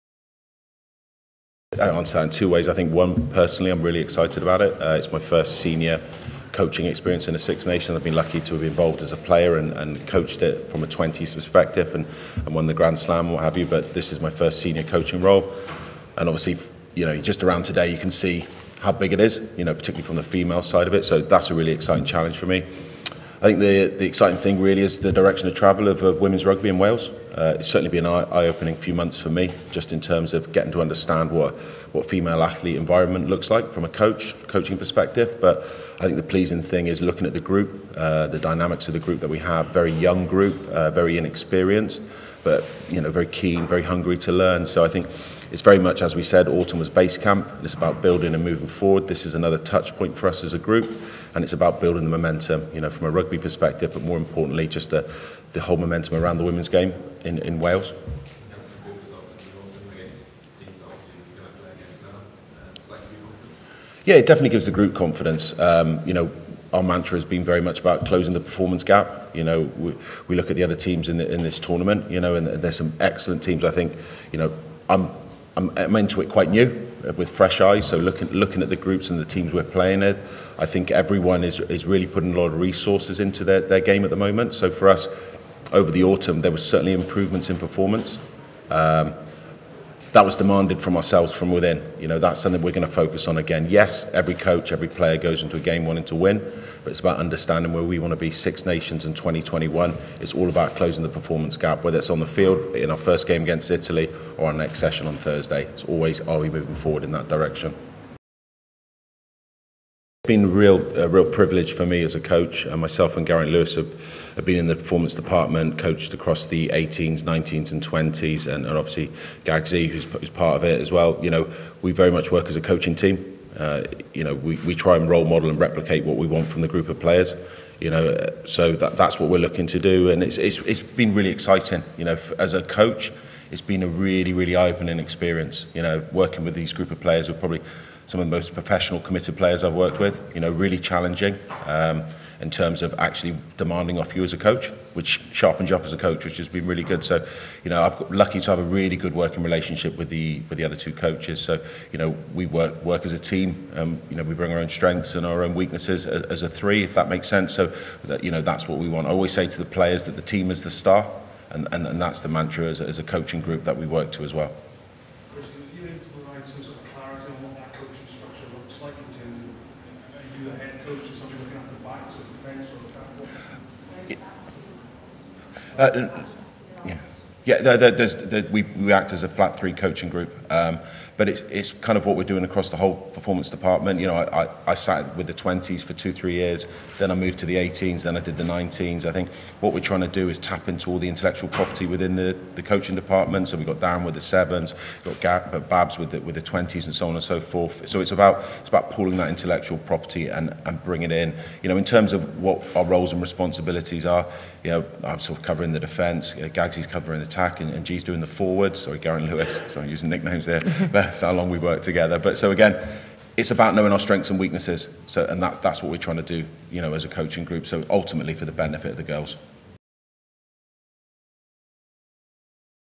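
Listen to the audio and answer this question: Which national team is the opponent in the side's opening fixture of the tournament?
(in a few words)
Italy.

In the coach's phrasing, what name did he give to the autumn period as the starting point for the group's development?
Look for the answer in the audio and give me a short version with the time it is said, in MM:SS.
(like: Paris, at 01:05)
Base camp, at 00:46.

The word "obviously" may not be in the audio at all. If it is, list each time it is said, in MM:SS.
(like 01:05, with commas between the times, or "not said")
00:16, 01:58.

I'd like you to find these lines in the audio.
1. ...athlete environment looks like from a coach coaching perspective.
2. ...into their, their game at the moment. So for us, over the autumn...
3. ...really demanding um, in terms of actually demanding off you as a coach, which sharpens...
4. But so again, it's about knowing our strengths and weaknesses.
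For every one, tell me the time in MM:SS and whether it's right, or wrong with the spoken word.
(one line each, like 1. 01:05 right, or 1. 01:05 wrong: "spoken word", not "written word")
1. 00:32 right
2. 01:23 right
3. 02:20 wrong: "challenging", not "demanding"
4. 03:32 right.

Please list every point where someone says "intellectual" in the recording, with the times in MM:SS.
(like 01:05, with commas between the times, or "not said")
03:11, 03:19.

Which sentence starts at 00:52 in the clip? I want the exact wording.
You know, from a rugby perspective, but more importantly, just the the whole momentum around the women's game in, in Wales.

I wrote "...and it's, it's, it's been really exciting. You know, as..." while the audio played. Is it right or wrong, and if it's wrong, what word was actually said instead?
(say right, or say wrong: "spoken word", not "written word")
right.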